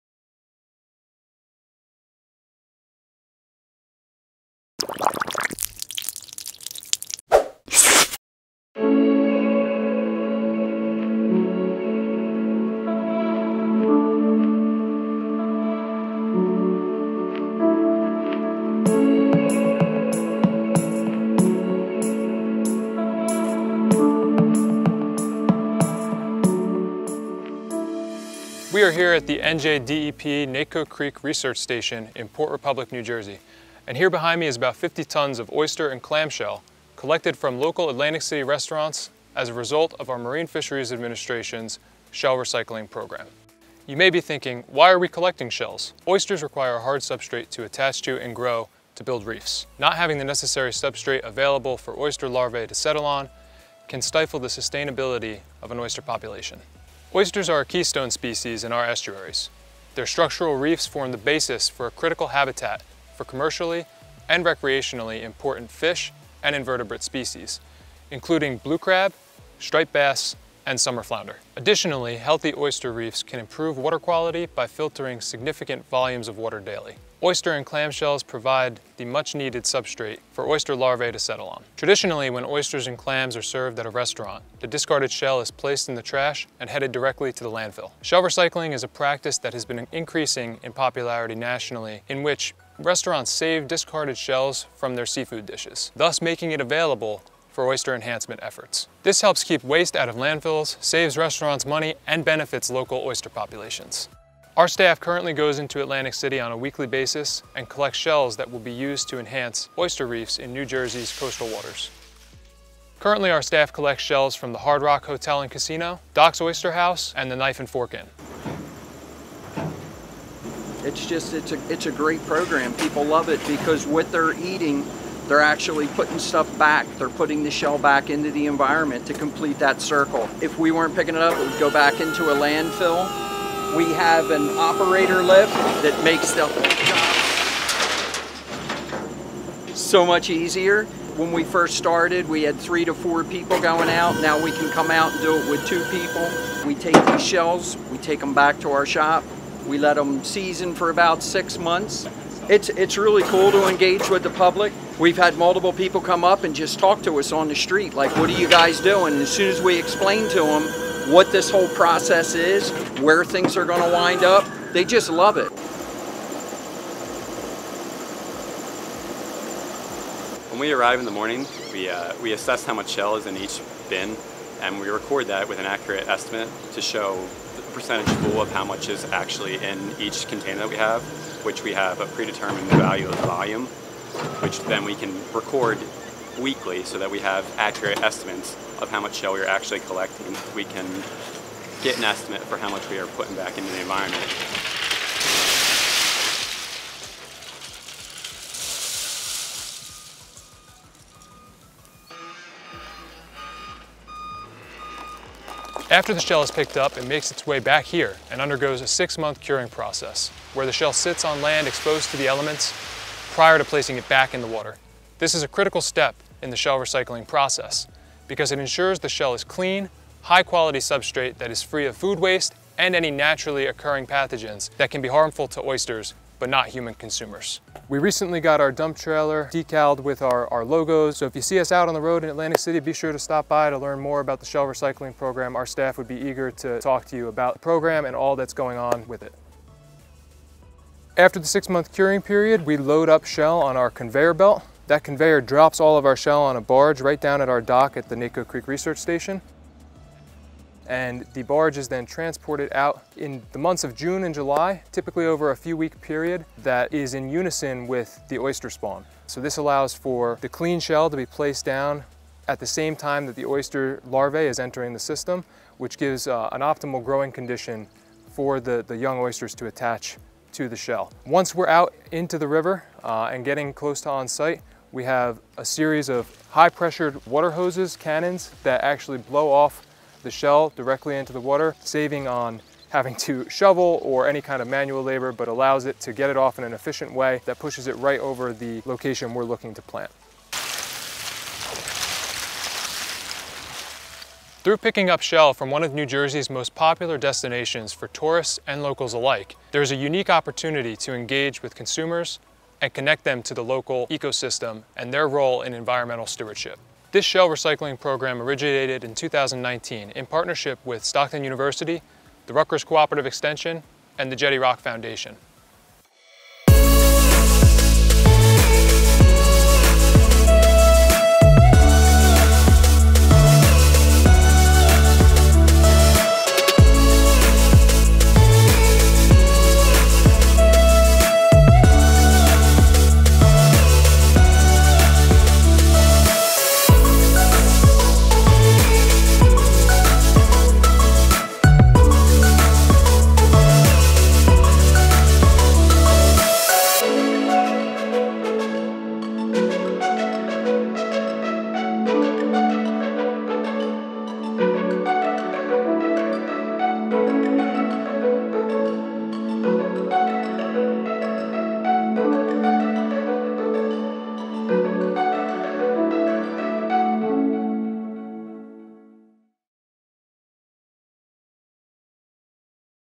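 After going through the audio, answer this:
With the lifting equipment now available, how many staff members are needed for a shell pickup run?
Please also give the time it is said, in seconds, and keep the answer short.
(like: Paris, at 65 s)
2, at 145 s.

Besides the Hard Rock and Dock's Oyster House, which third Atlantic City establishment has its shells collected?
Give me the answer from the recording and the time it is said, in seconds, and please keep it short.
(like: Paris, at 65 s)
Knife and Fork Inn, at 117 s.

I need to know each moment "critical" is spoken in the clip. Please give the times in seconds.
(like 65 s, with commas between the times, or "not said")
61 s, 215 s.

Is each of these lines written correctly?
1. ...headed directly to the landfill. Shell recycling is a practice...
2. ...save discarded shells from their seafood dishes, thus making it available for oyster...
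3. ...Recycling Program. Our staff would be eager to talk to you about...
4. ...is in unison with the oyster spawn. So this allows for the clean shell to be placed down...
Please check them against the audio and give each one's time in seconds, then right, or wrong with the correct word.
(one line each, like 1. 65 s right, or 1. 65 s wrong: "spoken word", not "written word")
1. 86 s right
2. 93 s right
3. 234 s right
4. 256 s right.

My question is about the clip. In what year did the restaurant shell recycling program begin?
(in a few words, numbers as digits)
2019.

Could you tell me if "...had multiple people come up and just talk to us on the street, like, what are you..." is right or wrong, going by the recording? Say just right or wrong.
right.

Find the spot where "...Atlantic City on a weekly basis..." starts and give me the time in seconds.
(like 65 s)
105 s.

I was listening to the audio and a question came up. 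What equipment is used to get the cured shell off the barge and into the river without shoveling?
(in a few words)
high pressured water hoses.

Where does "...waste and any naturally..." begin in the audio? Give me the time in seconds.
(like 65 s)
222 s.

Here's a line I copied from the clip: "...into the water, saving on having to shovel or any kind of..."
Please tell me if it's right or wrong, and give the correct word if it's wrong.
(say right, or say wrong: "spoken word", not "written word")
right.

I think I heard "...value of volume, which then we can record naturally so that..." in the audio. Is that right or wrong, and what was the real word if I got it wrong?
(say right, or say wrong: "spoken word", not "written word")
wrong: "weekly", not "naturally".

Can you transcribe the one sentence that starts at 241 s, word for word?
After the six month curing period, we load up shell on our conveyor belt.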